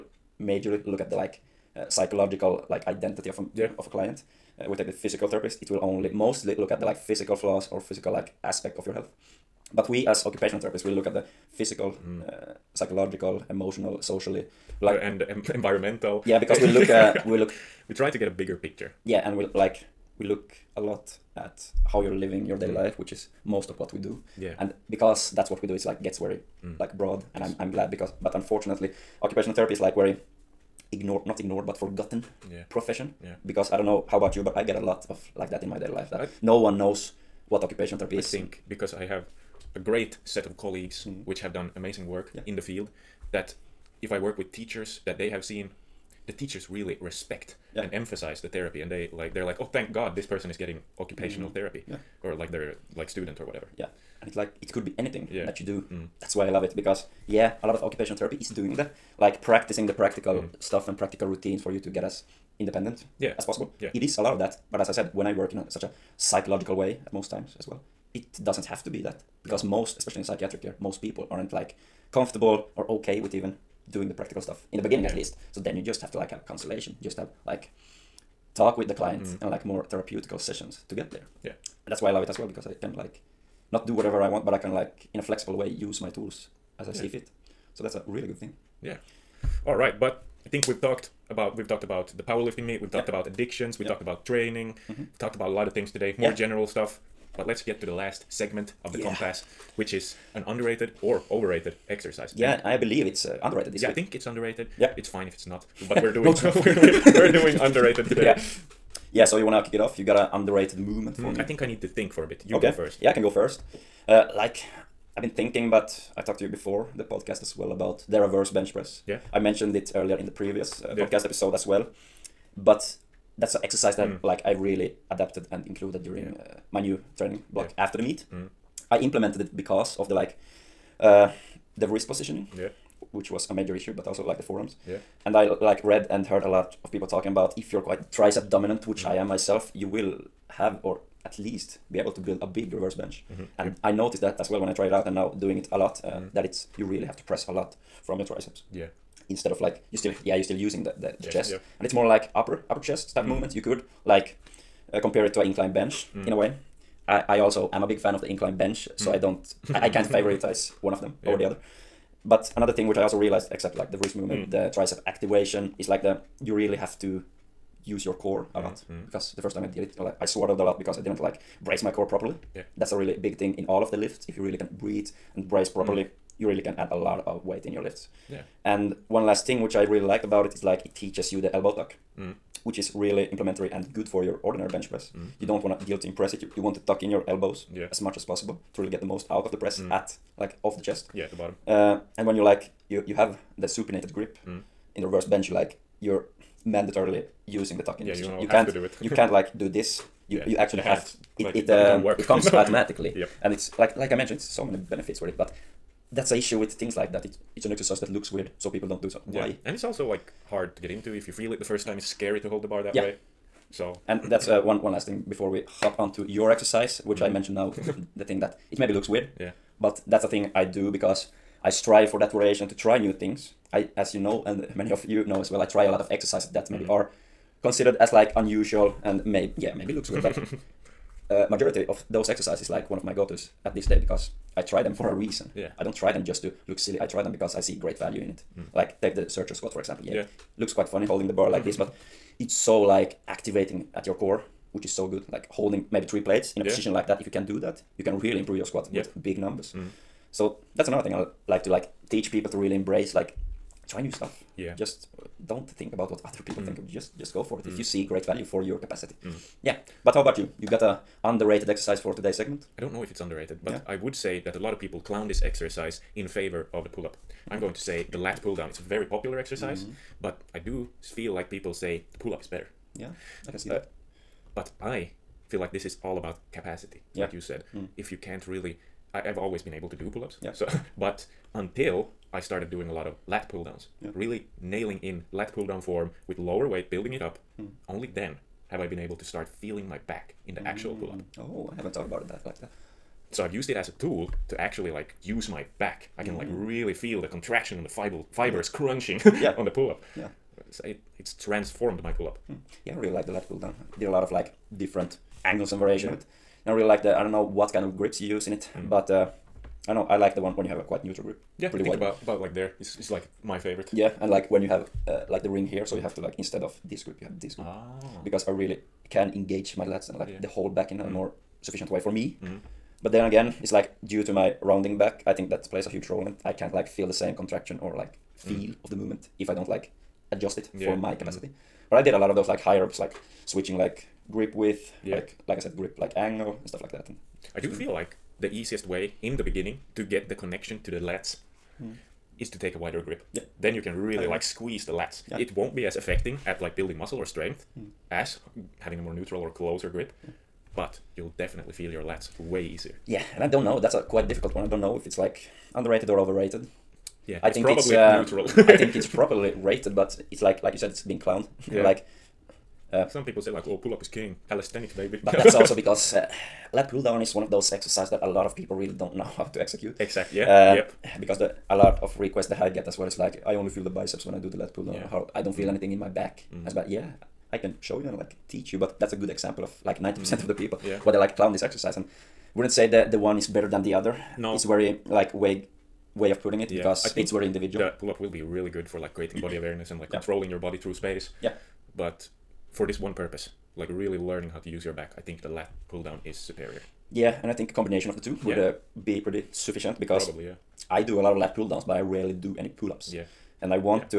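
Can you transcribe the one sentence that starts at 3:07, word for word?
as much as possible really get the most out of the press mm.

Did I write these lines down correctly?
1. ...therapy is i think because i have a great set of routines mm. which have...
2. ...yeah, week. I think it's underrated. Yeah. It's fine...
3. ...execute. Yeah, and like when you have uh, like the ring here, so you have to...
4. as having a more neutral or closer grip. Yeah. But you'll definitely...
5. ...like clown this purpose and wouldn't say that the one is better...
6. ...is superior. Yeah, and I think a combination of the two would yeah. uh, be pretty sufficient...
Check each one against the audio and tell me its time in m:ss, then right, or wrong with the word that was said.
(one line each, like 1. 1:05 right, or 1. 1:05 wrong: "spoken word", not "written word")
1. 0:37 wrong: "colleagues", not "routines"
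2. 1:43 right
3. 5:13 wrong: "favorite", not "execute"
4. 5:48 right
5. 6:21 wrong: "exercise", not "purpose"
6. 6:36 right.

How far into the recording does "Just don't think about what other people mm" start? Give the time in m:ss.
4:14.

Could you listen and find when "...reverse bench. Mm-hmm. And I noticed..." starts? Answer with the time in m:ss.
2:22.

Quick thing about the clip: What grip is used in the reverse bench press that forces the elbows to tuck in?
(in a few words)
supinated grip.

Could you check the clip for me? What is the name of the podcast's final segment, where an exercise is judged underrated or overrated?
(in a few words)
compass.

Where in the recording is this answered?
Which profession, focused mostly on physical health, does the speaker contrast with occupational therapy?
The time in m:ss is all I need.
0:04.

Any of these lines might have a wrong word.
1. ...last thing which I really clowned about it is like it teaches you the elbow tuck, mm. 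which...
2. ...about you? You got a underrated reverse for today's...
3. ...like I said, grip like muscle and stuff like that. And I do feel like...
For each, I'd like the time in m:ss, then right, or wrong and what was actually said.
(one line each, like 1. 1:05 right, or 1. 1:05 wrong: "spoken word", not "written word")
1. 2:59 wrong: "liked", not "clowned"
2. 4:20 wrong: "exercise", not "reverse"
3. 5:35 wrong: "angle", not "muscle".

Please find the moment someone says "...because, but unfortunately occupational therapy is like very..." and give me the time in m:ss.
0:27.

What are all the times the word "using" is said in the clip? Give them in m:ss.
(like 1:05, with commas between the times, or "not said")
2:30, 3:17.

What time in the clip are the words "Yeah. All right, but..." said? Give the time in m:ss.
1:28.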